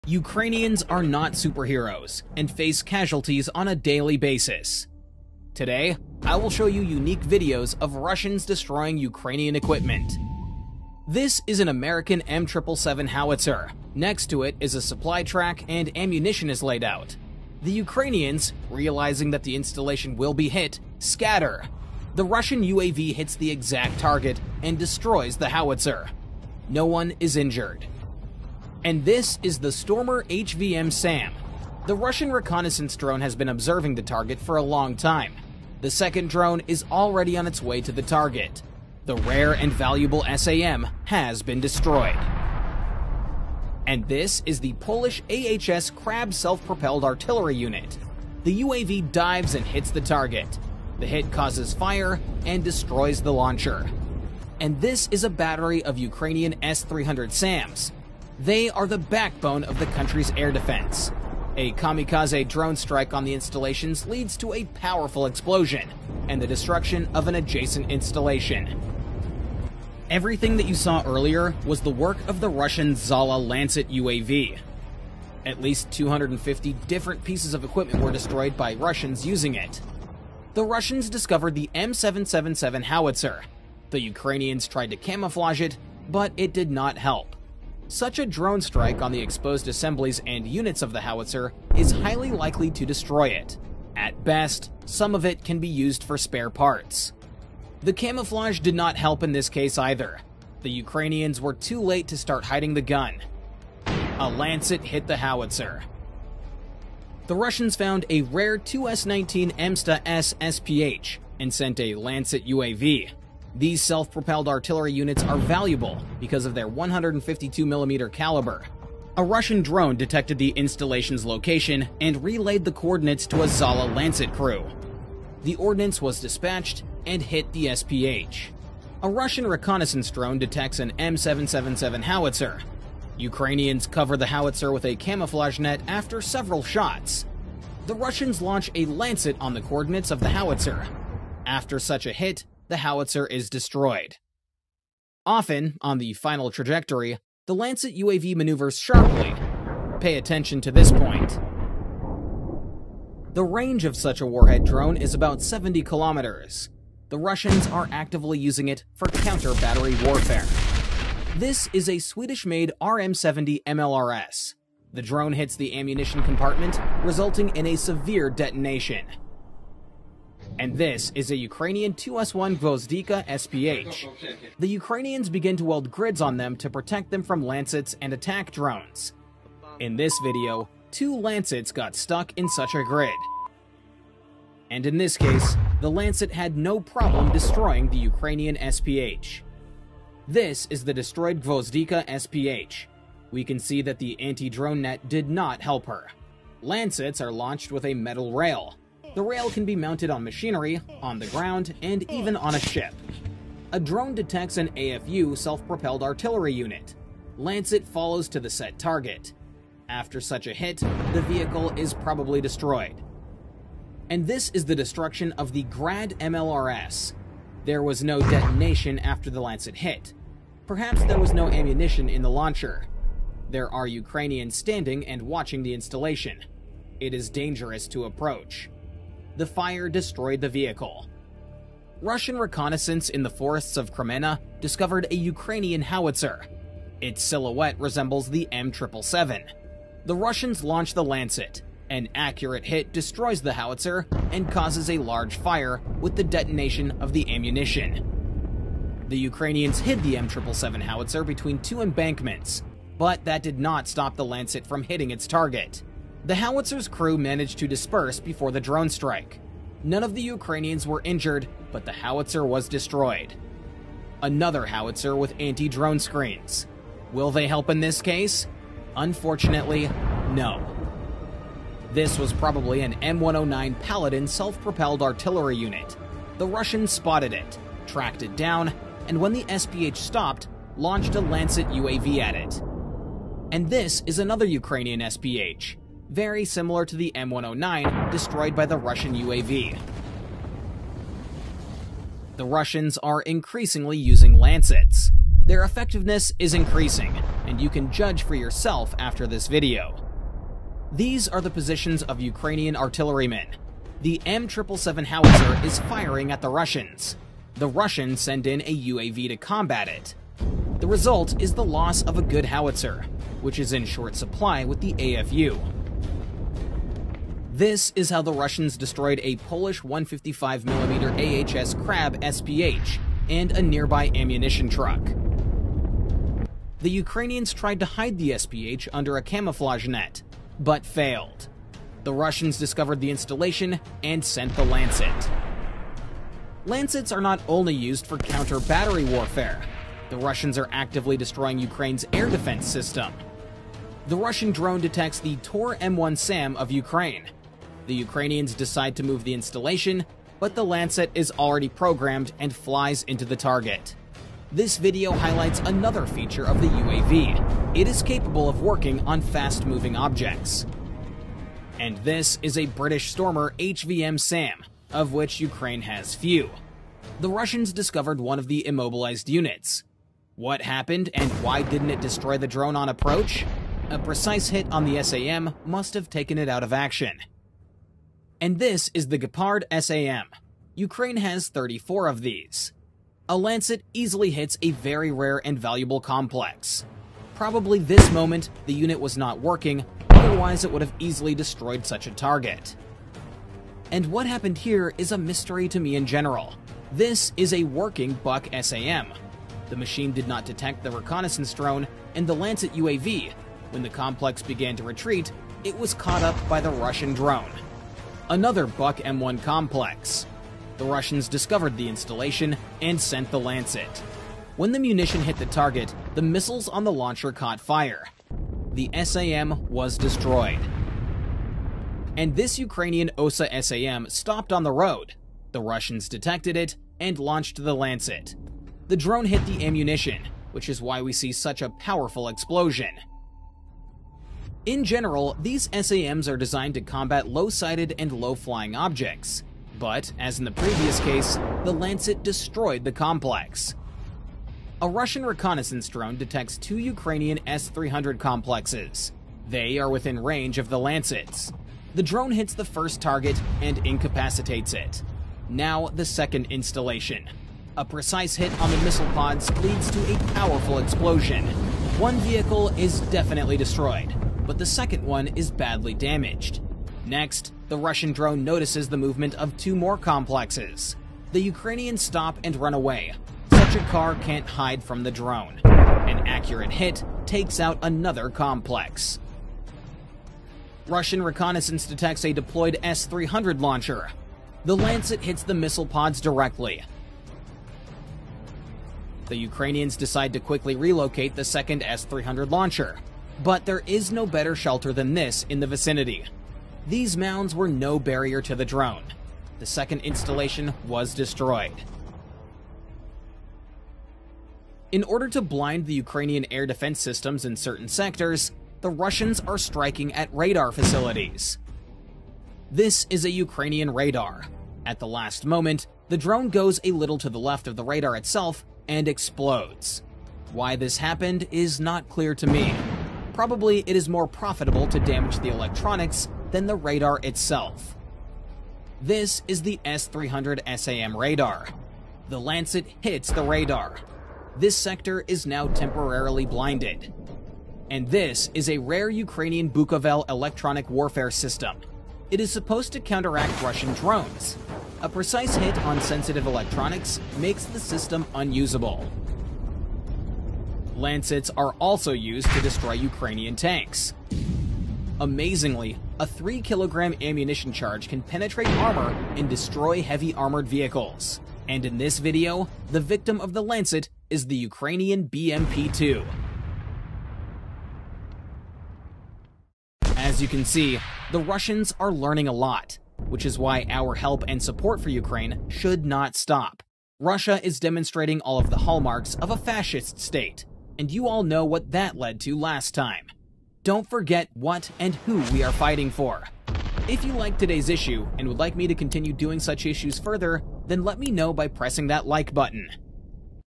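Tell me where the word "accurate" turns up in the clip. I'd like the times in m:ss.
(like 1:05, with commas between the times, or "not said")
4:02, 7:56.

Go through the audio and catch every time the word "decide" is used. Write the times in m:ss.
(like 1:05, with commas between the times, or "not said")
5:48, 8:09.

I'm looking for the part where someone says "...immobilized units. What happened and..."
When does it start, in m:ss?
6:08.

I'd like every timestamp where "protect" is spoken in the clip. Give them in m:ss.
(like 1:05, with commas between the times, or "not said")
2:56.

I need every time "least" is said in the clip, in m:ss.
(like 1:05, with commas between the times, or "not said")
1:15.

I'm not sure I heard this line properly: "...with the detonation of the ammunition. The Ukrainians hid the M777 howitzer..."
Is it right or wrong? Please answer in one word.
right.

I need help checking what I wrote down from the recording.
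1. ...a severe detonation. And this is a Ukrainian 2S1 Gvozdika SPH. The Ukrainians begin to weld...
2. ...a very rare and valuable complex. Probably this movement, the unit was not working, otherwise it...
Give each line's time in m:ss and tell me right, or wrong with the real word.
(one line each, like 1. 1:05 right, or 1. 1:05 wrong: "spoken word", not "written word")
1. 2:47 right
2. 6:24 wrong: "moment", not "movement".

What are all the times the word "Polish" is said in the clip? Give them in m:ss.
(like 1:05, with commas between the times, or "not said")
0:44, 5:19.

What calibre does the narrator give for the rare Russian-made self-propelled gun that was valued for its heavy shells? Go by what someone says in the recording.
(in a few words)
152mm.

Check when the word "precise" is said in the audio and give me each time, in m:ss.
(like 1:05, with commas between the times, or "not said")
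6:13, 7:37, 9:05.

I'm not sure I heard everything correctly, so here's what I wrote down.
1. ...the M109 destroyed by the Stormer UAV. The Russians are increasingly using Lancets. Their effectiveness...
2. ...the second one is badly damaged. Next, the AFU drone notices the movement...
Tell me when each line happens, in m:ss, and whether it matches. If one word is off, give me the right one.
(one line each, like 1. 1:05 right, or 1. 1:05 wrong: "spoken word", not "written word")
1. 4:46 wrong: "Russian", not "Stormer"
2. 7:44 wrong: "Russian", not "AFU".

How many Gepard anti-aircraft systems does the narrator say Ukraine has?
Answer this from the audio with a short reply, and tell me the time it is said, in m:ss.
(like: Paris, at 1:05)
34, at 6:21.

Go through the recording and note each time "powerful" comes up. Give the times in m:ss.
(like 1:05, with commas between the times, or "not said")
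1:04, 7:11, 7:40.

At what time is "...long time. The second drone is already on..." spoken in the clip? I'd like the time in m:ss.
0:34.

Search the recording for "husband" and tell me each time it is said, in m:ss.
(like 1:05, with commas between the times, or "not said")
not said.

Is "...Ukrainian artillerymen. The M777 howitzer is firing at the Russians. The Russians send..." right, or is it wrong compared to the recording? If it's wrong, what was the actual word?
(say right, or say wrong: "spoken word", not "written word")
right.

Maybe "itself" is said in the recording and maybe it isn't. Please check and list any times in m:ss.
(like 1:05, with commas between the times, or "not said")
8:38, 8:47.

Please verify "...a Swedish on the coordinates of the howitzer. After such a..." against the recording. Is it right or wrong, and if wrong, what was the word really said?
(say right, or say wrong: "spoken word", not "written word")
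wrong: "Lancet", not "Swedish".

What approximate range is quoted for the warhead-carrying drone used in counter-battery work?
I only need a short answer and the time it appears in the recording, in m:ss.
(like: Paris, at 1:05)
70 kilometers, at 2:35.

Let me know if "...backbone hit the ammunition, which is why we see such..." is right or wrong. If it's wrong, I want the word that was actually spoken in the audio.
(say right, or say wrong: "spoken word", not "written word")
wrong: "drone", not "backbone".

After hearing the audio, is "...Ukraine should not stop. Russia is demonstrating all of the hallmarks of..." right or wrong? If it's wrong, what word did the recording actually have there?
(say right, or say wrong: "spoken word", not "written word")
right.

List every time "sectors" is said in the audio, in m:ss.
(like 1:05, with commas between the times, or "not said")
8:27, 8:54.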